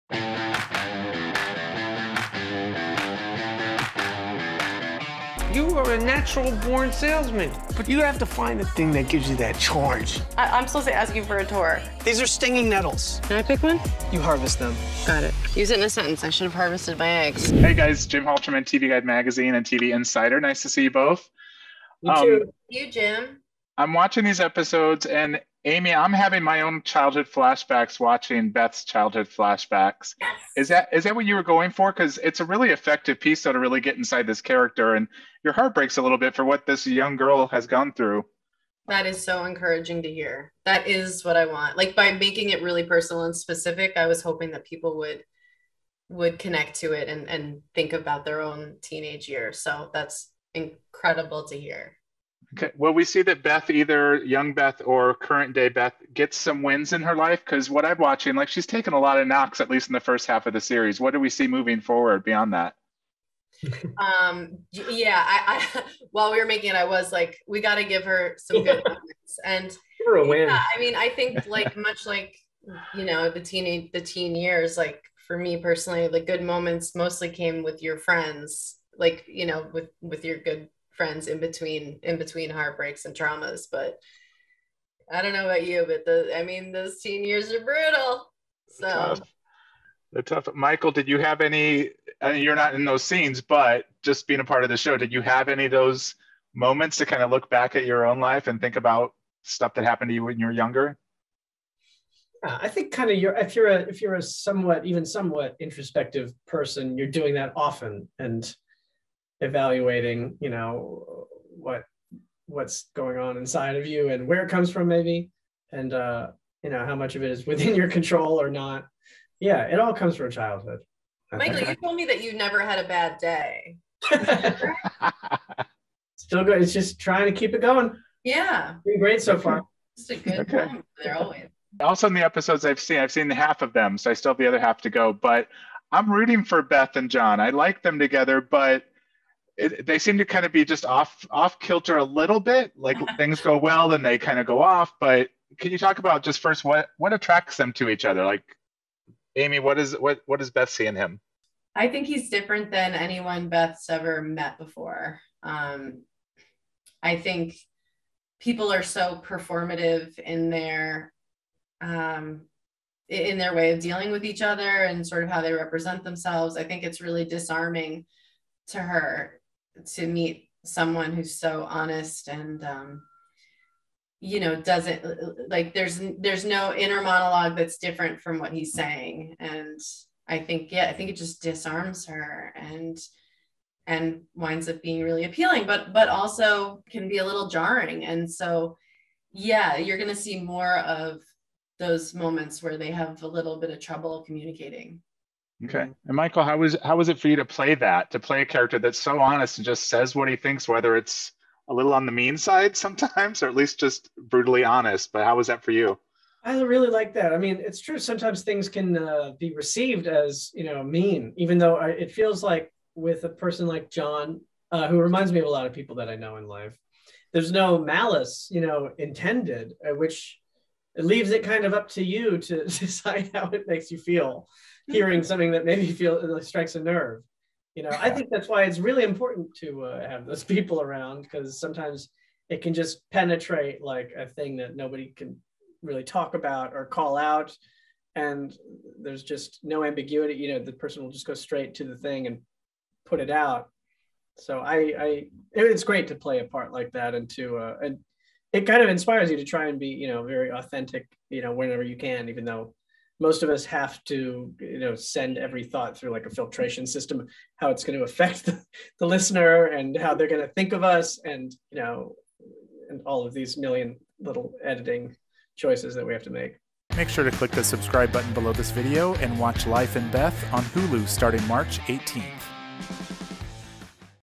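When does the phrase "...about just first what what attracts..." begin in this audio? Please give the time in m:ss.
2:25.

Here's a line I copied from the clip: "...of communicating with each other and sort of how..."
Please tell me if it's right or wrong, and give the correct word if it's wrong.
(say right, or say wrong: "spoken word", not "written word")
wrong: "dealing", not "communicating".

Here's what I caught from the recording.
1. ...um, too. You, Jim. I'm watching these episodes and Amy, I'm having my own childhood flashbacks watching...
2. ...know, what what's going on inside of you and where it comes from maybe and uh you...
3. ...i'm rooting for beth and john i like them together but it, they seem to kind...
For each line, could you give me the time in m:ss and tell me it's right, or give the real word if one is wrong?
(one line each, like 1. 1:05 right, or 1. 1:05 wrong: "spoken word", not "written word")
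1. 0:22 right
2. 1:50 right
3. 2:15 right.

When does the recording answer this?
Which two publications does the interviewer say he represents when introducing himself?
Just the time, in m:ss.
0:18.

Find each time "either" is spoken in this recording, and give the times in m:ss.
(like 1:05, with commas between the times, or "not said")
0:53.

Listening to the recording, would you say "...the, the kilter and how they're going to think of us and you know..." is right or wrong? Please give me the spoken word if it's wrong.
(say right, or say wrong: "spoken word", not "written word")
wrong: "listener", not "kilter".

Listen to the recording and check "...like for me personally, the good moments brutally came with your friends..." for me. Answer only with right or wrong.
wrong.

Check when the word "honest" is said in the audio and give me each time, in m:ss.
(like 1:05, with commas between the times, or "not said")
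2:51, 3:19, 3:24.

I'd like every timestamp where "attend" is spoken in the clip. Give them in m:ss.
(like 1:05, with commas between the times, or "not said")
not said.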